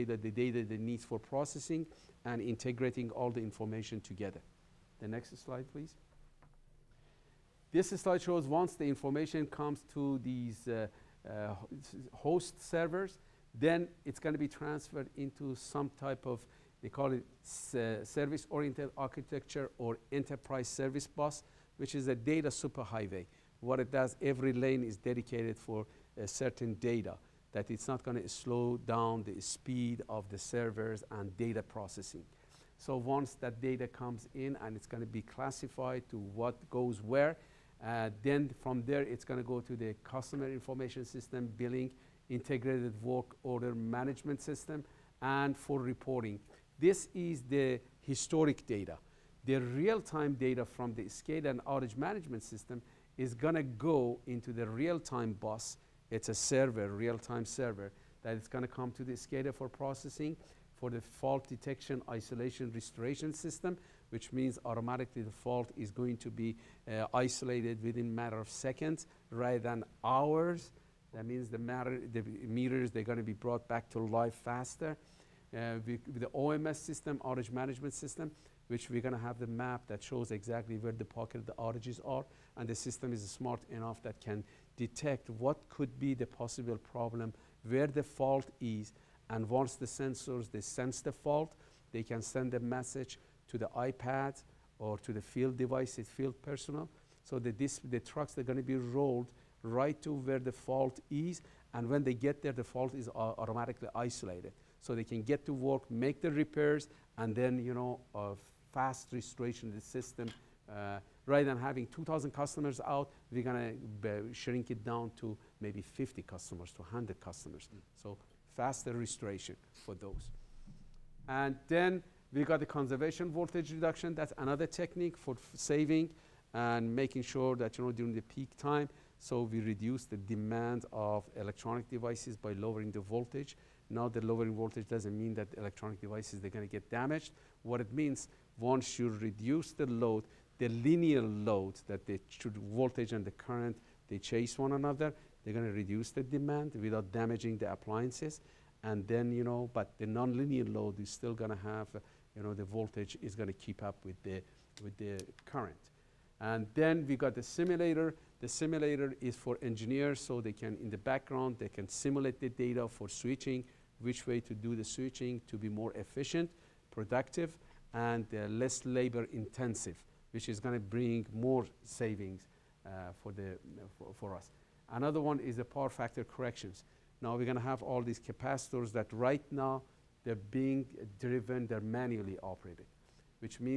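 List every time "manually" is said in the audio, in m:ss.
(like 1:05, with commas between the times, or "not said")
3:01.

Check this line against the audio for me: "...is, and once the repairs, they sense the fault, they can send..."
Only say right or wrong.
wrong.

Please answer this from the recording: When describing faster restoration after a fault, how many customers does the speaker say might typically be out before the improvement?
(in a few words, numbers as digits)
2,000.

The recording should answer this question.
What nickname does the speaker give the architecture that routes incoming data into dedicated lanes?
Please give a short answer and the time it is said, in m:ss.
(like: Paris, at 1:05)
data superhighway, at 0:22.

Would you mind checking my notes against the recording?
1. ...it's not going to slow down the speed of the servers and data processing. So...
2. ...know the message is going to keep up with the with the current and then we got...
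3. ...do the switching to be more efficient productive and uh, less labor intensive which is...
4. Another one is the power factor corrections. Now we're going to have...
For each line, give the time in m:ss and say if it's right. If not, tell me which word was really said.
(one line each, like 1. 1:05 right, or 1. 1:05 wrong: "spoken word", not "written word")
1. 0:27 right
2. 2:32 wrong: "voltage", not "message"
3. 2:44 right
4. 2:54 right.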